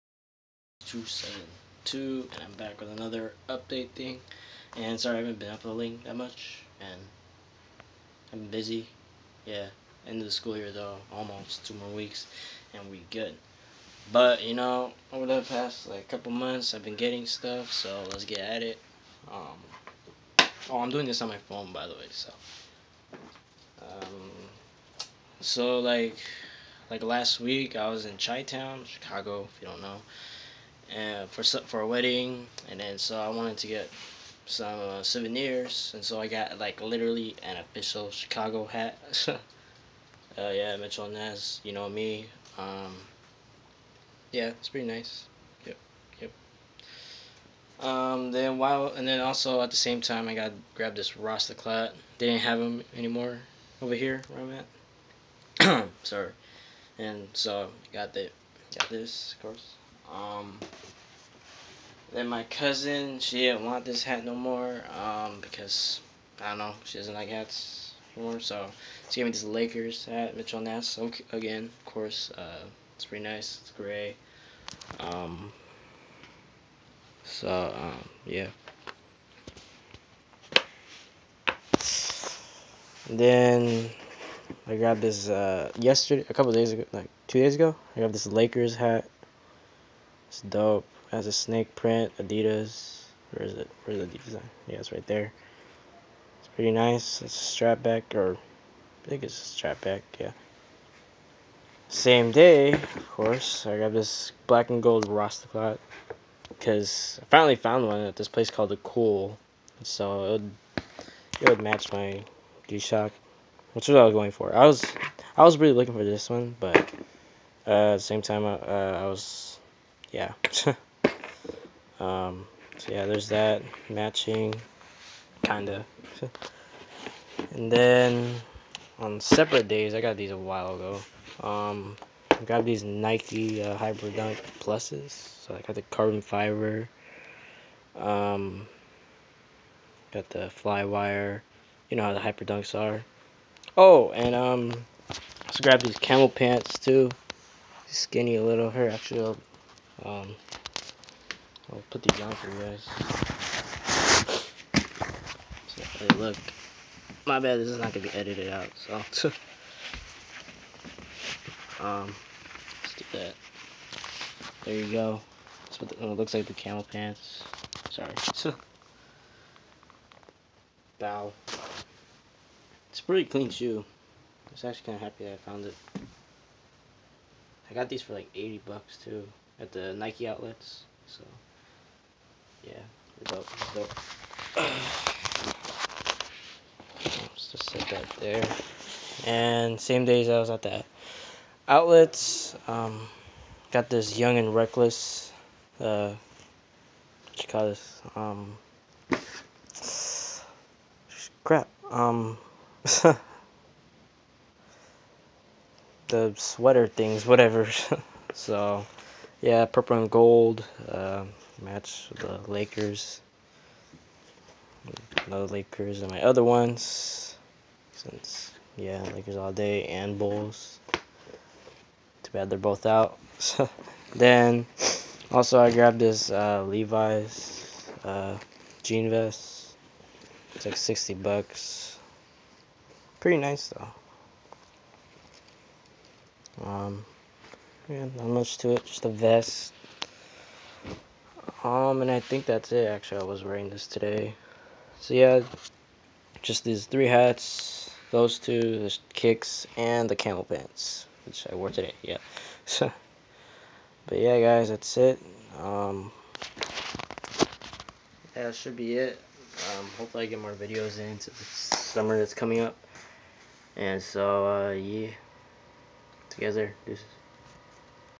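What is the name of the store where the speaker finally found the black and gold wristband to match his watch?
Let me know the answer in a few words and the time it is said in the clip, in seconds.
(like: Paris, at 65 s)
The Cool, at 108 s.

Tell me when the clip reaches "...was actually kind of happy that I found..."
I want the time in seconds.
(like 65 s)
174 s.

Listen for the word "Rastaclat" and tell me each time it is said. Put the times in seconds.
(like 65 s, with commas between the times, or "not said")
51 s, 105 s.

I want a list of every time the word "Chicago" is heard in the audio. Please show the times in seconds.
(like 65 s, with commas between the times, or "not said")
28 s, 38 s.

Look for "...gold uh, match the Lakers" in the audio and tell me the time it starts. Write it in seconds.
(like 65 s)
210 s.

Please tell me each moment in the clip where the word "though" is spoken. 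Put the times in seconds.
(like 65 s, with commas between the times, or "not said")
10 s, 233 s.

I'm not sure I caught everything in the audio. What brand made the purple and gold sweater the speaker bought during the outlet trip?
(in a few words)
Young and Reckless.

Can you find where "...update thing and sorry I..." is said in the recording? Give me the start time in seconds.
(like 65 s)
3 s.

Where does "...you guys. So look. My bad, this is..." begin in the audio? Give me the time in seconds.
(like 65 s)
152 s.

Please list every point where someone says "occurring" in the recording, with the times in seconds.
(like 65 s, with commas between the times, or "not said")
not said.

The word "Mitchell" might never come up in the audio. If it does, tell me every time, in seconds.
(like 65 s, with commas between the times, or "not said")
40 s, 70 s.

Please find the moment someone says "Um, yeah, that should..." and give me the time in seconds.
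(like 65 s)
255 s.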